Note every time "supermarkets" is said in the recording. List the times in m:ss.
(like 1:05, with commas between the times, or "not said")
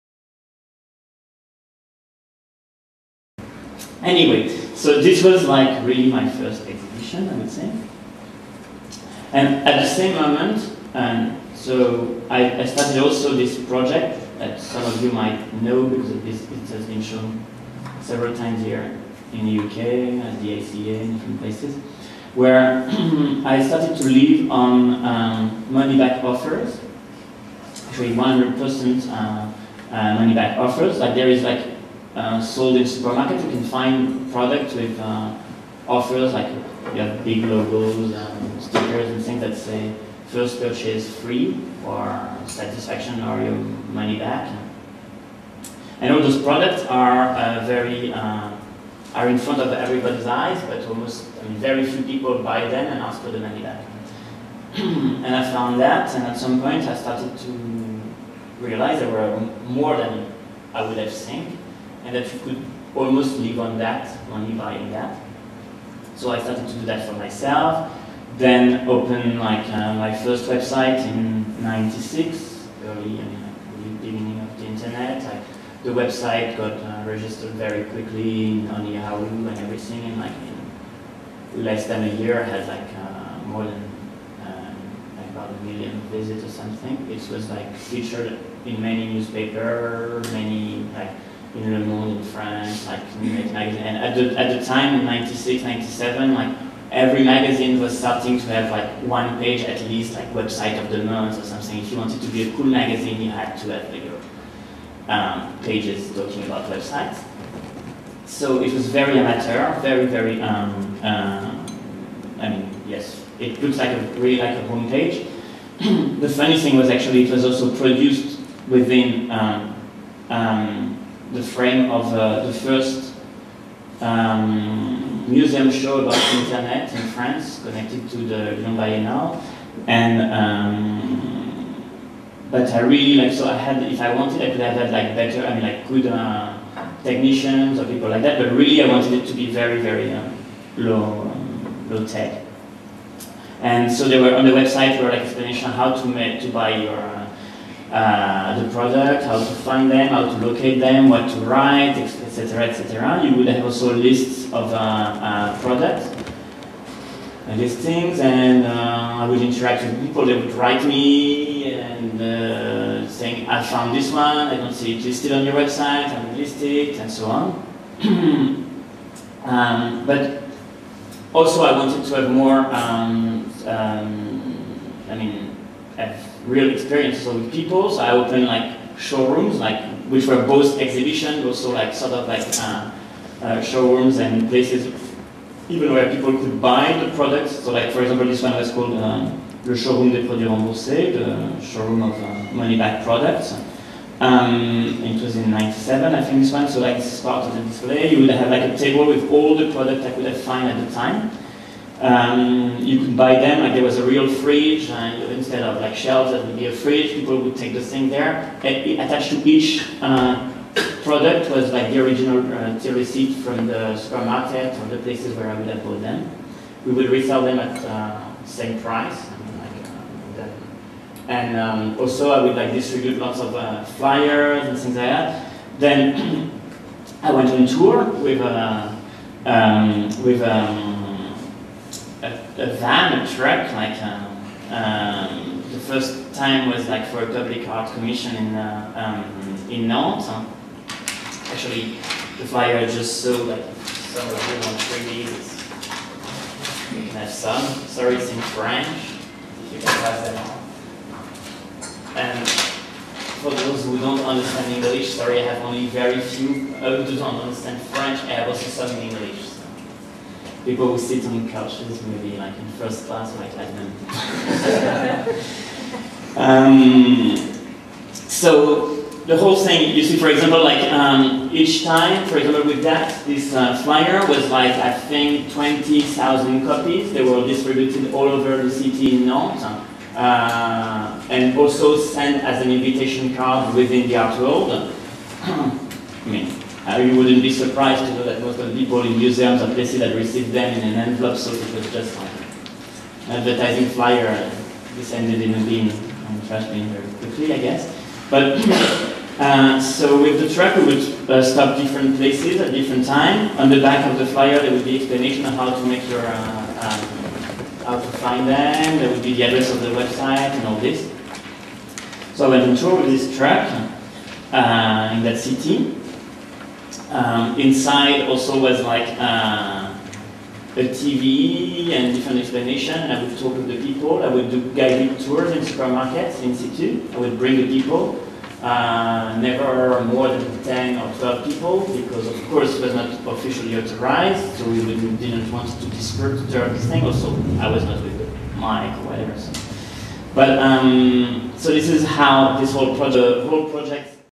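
0:32, 3:33, 5:25.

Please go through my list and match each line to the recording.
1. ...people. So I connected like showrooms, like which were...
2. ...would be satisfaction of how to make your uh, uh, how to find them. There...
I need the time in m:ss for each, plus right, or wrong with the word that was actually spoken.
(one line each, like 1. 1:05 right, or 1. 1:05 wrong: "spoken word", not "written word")
1. 2:57 wrong: "opened", not "connected"
2. 5:04 wrong: "explanation", not "satisfaction".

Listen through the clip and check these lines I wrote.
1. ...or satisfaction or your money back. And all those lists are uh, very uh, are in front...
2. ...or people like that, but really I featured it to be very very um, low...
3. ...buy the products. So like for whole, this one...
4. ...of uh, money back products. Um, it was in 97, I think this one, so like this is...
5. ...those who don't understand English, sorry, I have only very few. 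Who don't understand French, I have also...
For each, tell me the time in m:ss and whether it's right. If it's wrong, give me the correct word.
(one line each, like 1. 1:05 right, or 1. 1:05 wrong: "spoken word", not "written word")
1. 0:41 wrong: "products", not "lists"
2. 2:17 wrong: "wanted", not "featured"
3. 3:06 wrong: "example", not "whole"
4. 3:12 right
5. 4:13 right.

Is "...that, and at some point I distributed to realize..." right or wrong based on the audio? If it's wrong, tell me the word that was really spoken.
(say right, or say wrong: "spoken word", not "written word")
wrong: "started", not "distributed".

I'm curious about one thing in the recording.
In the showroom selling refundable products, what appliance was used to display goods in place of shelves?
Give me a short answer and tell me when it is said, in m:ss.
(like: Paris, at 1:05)
a fridge, at 3:26.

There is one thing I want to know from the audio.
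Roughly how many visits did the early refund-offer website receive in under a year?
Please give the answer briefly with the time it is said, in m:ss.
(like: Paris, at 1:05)
about a million, at 1:25.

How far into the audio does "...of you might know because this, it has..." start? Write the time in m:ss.
0:14.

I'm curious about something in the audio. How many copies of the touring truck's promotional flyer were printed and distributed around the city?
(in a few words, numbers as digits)
20,000.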